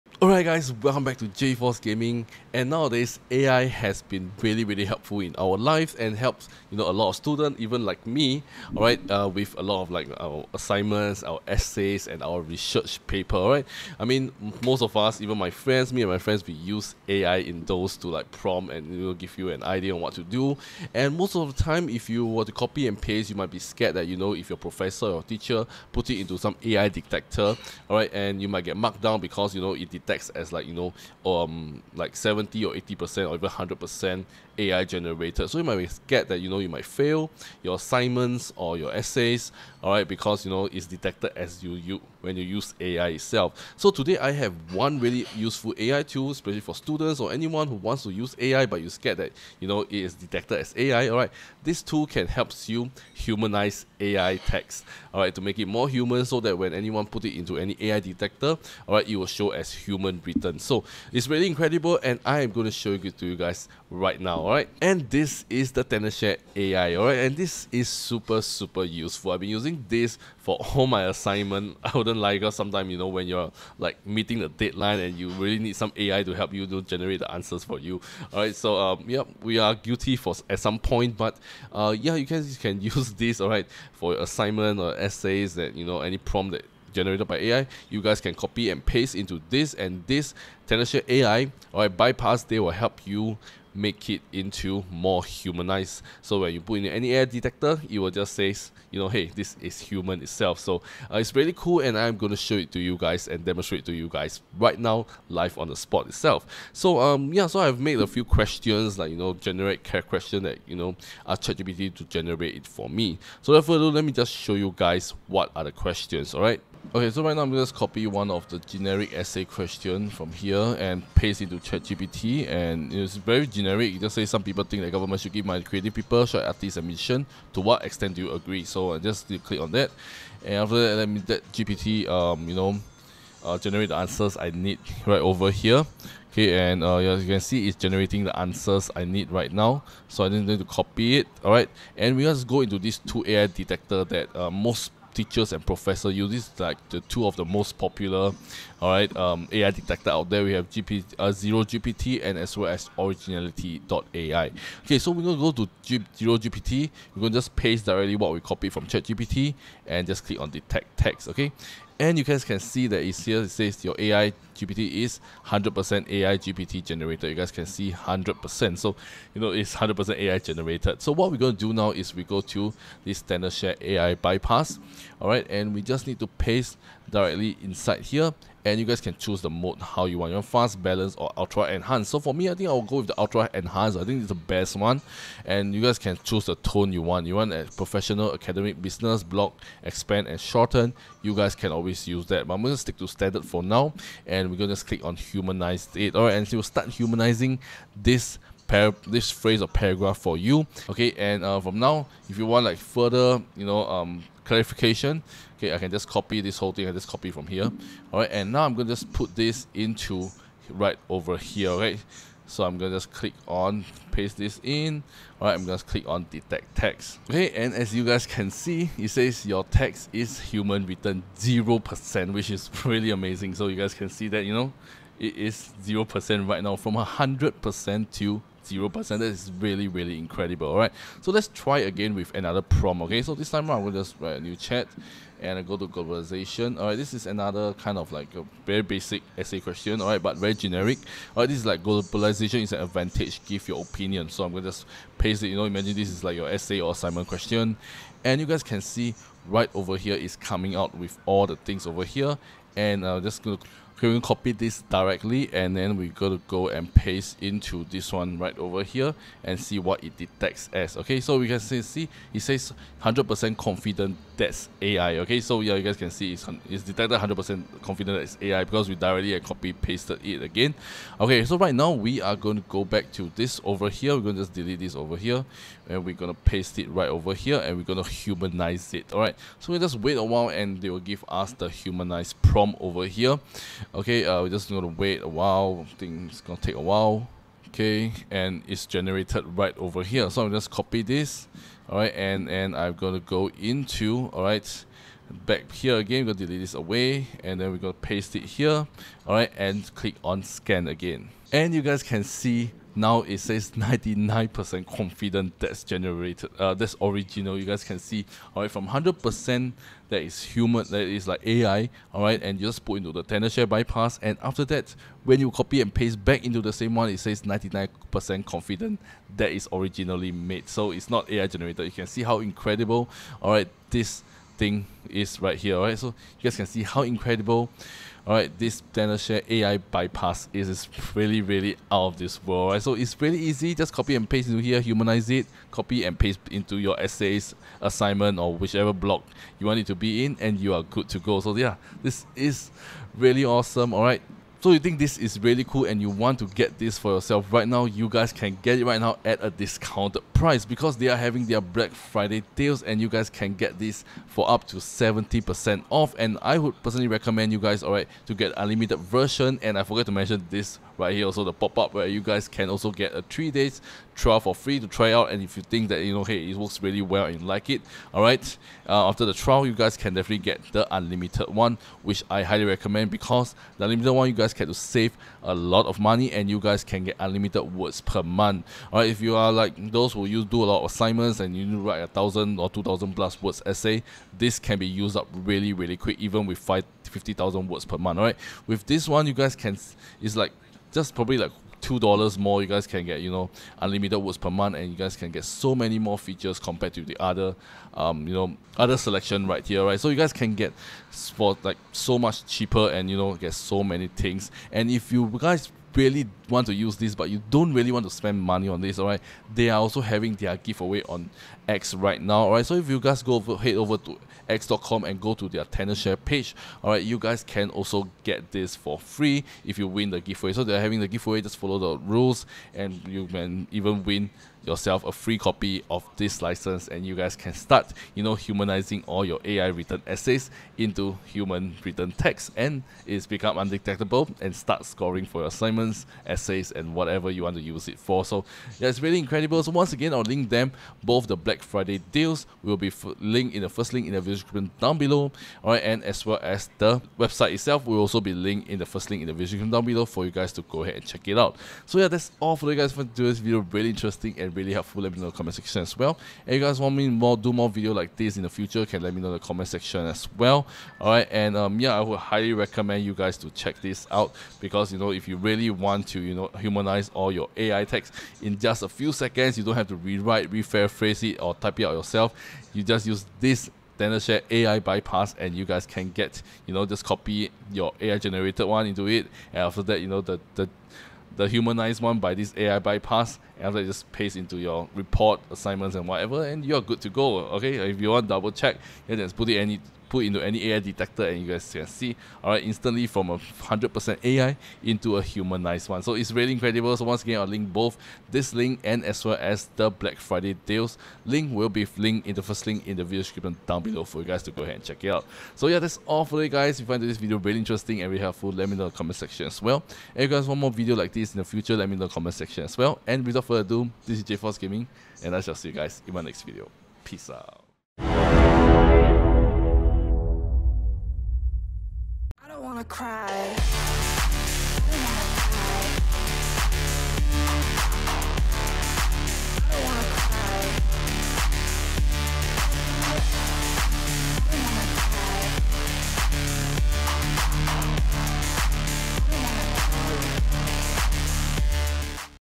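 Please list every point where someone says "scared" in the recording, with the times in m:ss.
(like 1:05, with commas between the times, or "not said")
0:23, 0:48.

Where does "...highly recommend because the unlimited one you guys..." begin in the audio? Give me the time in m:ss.
6:12.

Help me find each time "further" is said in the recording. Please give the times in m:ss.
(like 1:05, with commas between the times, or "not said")
3:22, 8:33.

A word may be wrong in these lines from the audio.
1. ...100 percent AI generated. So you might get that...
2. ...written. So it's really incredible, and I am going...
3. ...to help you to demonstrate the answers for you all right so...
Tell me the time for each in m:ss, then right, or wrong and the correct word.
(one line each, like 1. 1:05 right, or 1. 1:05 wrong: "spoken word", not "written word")
1. 0:33 right
2. 1:00 right
3. 1:16 wrong: "generate", not "demonstrate".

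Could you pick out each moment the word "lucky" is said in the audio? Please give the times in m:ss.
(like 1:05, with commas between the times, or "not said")
not said.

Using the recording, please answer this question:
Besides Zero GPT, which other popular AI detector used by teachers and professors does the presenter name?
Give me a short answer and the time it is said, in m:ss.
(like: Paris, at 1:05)
Originality.ai, at 2:32.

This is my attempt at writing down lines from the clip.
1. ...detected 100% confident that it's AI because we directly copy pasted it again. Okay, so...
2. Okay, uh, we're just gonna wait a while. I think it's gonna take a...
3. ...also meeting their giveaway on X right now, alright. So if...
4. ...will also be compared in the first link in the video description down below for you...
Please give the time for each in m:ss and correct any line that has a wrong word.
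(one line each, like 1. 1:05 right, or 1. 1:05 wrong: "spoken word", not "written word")
1. 4:26 right
2. 4:43 right
3. 6:49 wrong: "having", not "meeting"
4. 7:27 wrong: "linked", not "compared".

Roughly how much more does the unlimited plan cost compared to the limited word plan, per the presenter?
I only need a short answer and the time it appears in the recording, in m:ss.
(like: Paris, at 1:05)
2 dollars, at 6:31.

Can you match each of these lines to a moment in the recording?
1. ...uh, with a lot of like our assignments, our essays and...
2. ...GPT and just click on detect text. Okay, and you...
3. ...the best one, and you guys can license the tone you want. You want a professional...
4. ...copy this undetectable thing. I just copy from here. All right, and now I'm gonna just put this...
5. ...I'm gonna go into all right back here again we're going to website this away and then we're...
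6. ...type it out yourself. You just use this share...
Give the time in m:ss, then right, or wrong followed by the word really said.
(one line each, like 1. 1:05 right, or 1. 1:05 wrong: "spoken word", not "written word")
1. 0:09 right
2. 2:39 right
3. 3:04 wrong: "choose", not "license"
4. 3:26 wrong: "whole", not "undetectable"
5. 4:52 wrong: "delete", not "website"
6. 7:51 right.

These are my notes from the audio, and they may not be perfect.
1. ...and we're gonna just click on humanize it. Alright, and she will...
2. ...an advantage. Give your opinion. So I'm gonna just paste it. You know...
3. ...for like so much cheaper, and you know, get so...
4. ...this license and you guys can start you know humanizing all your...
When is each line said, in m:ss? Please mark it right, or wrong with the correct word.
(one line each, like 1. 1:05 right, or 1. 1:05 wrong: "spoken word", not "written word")
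1. 3:14 right
2. 4:02 right
3. 6:41 right
4. 7:06 right.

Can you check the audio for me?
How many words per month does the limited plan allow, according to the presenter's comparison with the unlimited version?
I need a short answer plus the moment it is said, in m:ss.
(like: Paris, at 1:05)
50,000, at 6:27.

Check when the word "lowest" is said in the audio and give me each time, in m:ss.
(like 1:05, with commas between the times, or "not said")
not said.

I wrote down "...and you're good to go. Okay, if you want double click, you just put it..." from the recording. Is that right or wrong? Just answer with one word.
wrong.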